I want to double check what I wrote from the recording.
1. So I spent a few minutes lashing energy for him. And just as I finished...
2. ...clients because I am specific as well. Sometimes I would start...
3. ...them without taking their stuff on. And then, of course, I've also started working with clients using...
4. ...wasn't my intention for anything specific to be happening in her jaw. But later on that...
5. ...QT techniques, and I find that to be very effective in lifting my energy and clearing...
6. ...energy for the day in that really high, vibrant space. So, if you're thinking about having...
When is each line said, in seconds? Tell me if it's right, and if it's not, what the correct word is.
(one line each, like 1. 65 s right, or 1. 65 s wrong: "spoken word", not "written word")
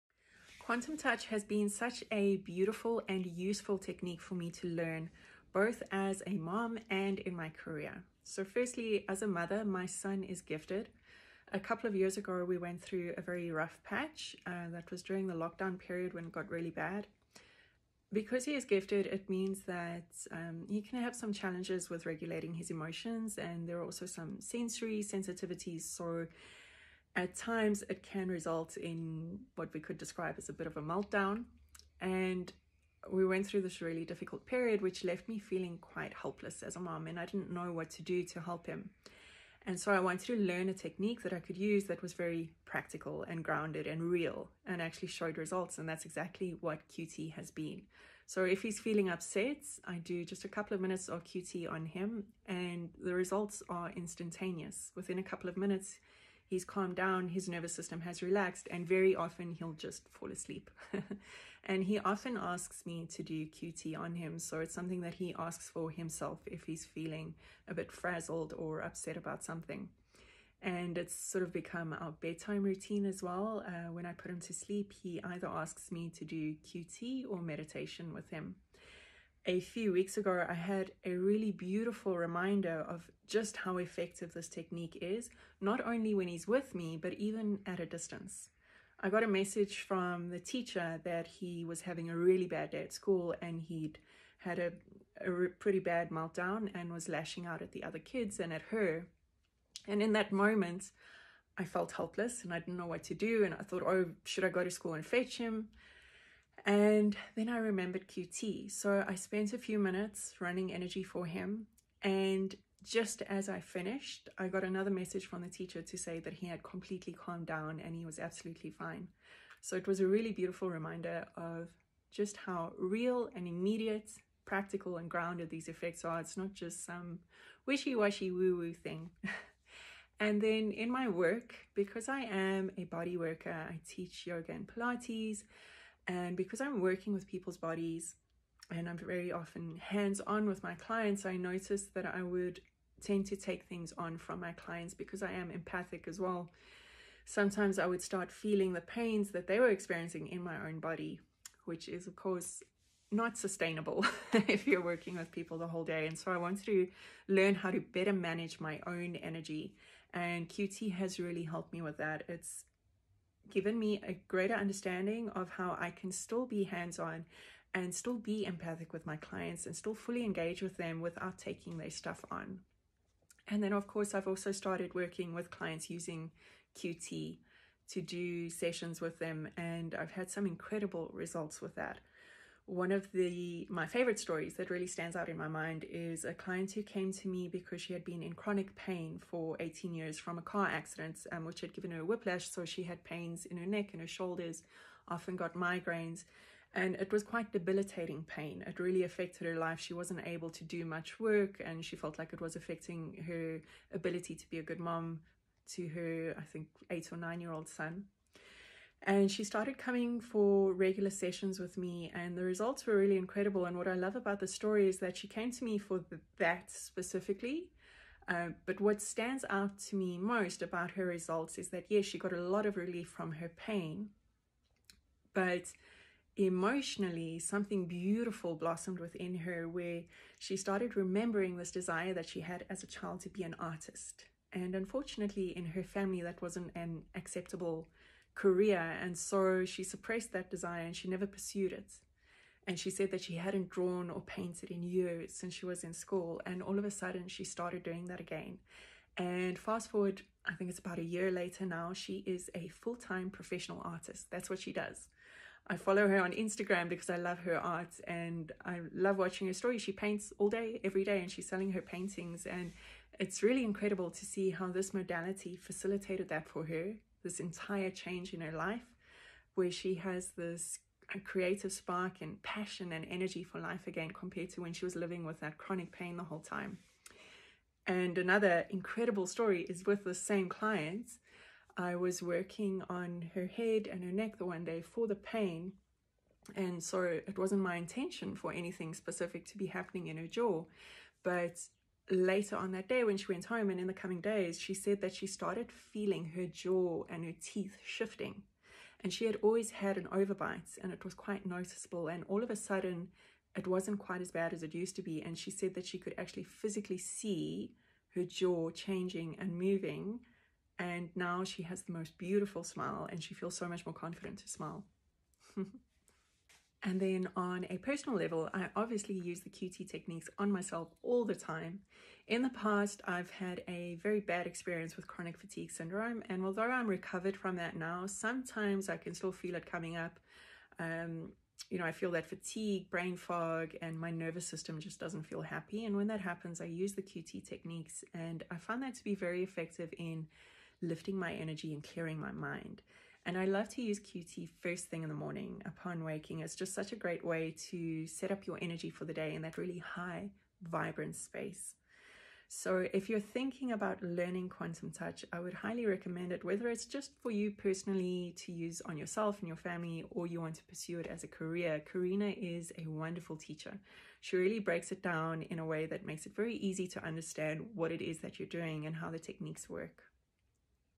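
1. 108 s wrong: "running", not "lashing"
2. 144 s wrong: "empathic", not "specific"
3. 170 s right
4. 287 s right
5. 337 s right
6. 348 s wrong: "learning", not "having".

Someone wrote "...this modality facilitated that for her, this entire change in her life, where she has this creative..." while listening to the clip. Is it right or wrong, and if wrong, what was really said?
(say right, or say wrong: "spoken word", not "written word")
right.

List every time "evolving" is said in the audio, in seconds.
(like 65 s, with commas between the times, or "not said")
not said.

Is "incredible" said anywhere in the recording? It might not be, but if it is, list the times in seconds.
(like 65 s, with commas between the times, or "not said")
180 s, 213 s, 263 s, 278 s.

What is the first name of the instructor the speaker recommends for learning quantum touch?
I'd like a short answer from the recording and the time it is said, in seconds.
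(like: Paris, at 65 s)
Karina, at 361 s.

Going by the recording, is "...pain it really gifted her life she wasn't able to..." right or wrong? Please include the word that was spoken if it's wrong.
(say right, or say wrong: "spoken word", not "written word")
wrong: "affected", not "gifted".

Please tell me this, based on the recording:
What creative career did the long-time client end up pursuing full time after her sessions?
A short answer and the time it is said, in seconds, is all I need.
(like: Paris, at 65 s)
Professional artist, at 253 s.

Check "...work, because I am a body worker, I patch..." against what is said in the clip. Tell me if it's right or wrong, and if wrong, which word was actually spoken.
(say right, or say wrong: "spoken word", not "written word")
wrong: "teach", not "patch".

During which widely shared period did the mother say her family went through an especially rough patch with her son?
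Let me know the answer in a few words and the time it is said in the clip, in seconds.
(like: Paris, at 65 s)
Lockdown, at 15 s.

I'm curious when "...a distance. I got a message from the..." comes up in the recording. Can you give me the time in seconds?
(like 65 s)
87 s.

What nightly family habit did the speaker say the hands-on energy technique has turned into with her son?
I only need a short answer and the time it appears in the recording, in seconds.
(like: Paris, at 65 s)
Bedtime routine, at 72 s.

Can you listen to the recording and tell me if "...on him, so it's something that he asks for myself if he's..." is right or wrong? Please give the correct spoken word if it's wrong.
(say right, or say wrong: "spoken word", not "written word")
wrong: "himself", not "myself".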